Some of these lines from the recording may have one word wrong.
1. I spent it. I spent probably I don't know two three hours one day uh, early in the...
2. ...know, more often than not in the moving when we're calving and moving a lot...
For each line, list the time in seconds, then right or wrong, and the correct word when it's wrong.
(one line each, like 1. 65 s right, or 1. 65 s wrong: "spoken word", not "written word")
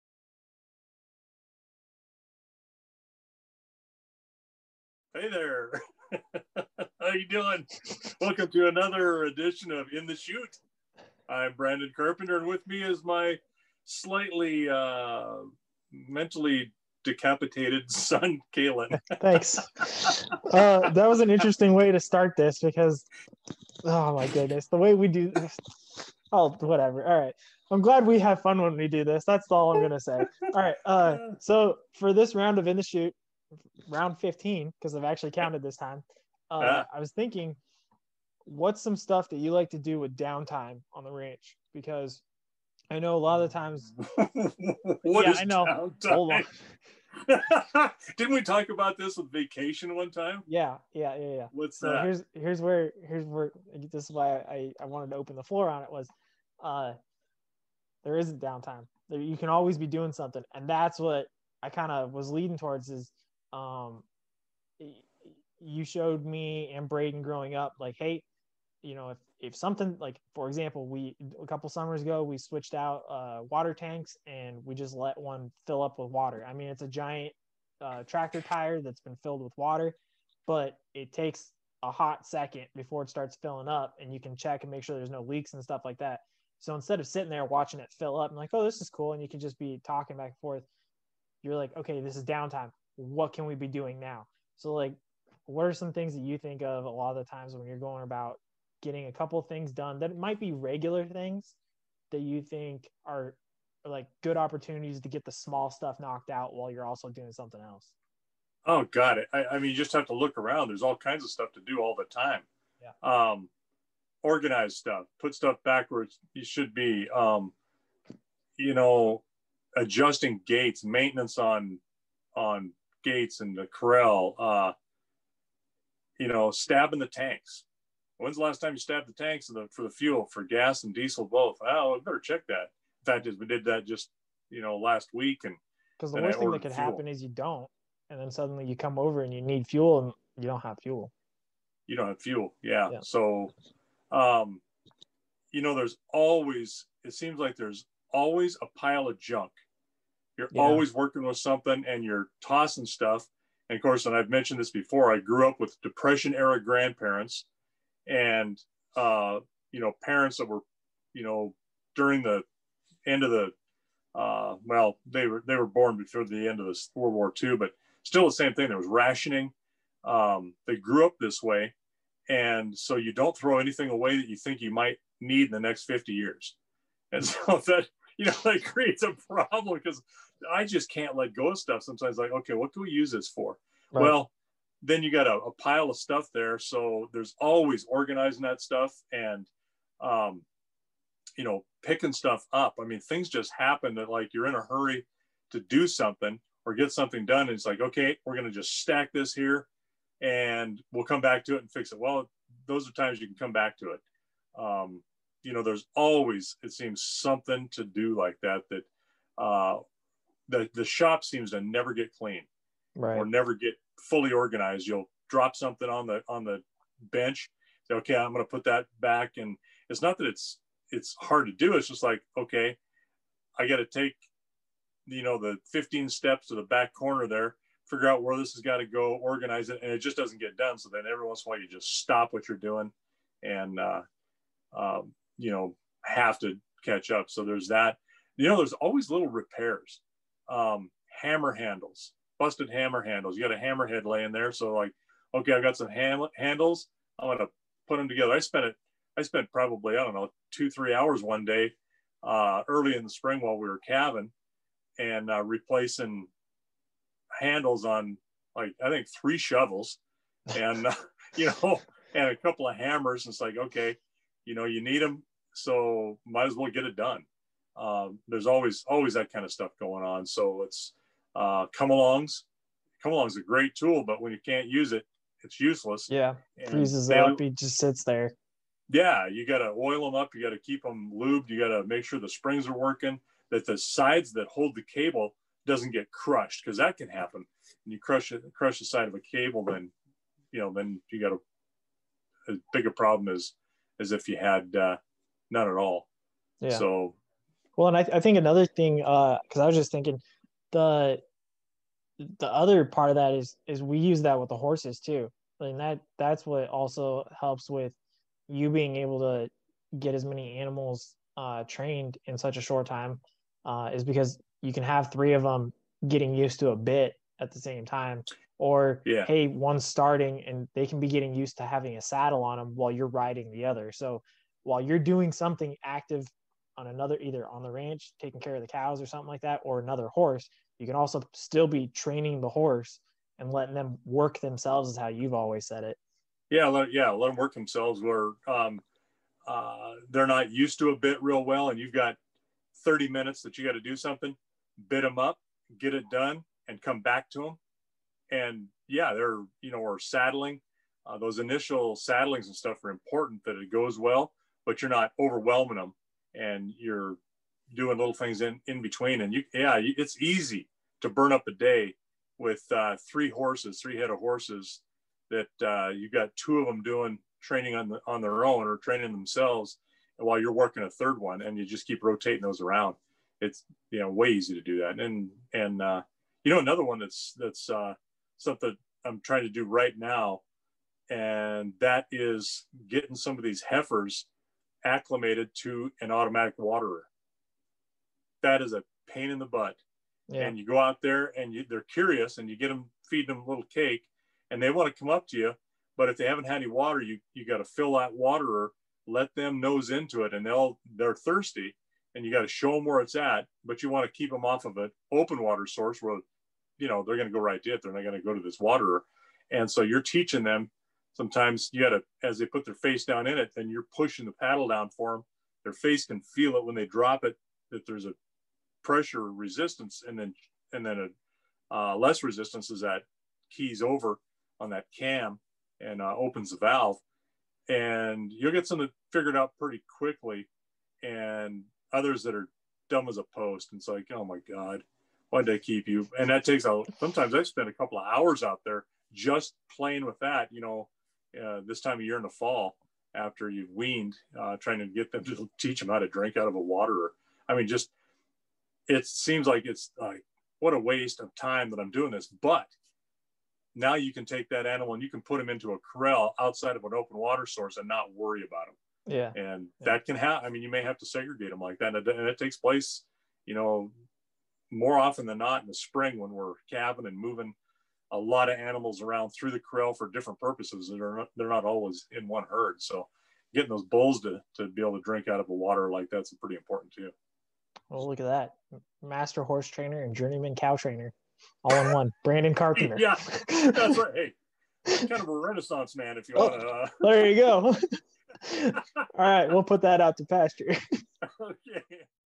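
1. 248 s right
2. 463 s wrong: "spring", not "moving".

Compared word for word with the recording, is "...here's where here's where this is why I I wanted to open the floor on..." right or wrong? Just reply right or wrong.
right.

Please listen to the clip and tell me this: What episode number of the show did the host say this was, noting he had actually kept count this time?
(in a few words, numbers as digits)
15.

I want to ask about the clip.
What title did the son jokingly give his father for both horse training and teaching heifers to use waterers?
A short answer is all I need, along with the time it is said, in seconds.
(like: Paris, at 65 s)
Renaissance man, at 485 s.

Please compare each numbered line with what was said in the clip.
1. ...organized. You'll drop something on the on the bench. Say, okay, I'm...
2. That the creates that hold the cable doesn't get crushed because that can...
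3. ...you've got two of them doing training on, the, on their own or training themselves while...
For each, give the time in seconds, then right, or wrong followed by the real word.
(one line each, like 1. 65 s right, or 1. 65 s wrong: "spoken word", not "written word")
1. 214 s right
2. 283 s wrong: "sides", not "creates"
3. 365 s right.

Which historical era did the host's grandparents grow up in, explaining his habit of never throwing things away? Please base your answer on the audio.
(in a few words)
Depression era.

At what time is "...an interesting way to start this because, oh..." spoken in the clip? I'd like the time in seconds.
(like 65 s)
21 s.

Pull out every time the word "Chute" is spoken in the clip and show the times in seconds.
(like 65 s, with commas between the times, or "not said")
10 s, 32 s.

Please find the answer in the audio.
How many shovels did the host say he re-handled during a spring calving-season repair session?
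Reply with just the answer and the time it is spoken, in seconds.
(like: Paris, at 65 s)
3, at 259 s.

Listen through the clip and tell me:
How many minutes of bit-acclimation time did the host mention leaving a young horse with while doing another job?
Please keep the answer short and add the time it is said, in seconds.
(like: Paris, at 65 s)
30, at 342 s.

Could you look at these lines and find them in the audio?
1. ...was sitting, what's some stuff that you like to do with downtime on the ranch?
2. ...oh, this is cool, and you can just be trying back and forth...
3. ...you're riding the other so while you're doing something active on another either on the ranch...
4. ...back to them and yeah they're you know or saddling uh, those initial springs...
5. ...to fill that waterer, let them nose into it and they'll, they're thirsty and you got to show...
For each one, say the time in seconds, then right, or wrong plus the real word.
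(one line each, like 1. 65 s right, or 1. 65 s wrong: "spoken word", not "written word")
1. 36 s wrong: "thinking", not "sitting"
2. 88 s wrong: "talking", not "trying"
3. 322 s right
4. 347 s wrong: "saddlings", not "springs"
5. 397 s right.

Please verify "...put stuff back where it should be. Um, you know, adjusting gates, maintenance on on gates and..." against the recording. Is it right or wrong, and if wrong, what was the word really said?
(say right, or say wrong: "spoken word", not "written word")
right.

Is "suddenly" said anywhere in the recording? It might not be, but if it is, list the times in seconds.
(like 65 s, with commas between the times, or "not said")
138 s.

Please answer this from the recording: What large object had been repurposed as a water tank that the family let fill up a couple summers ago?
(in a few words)
Tractor tire.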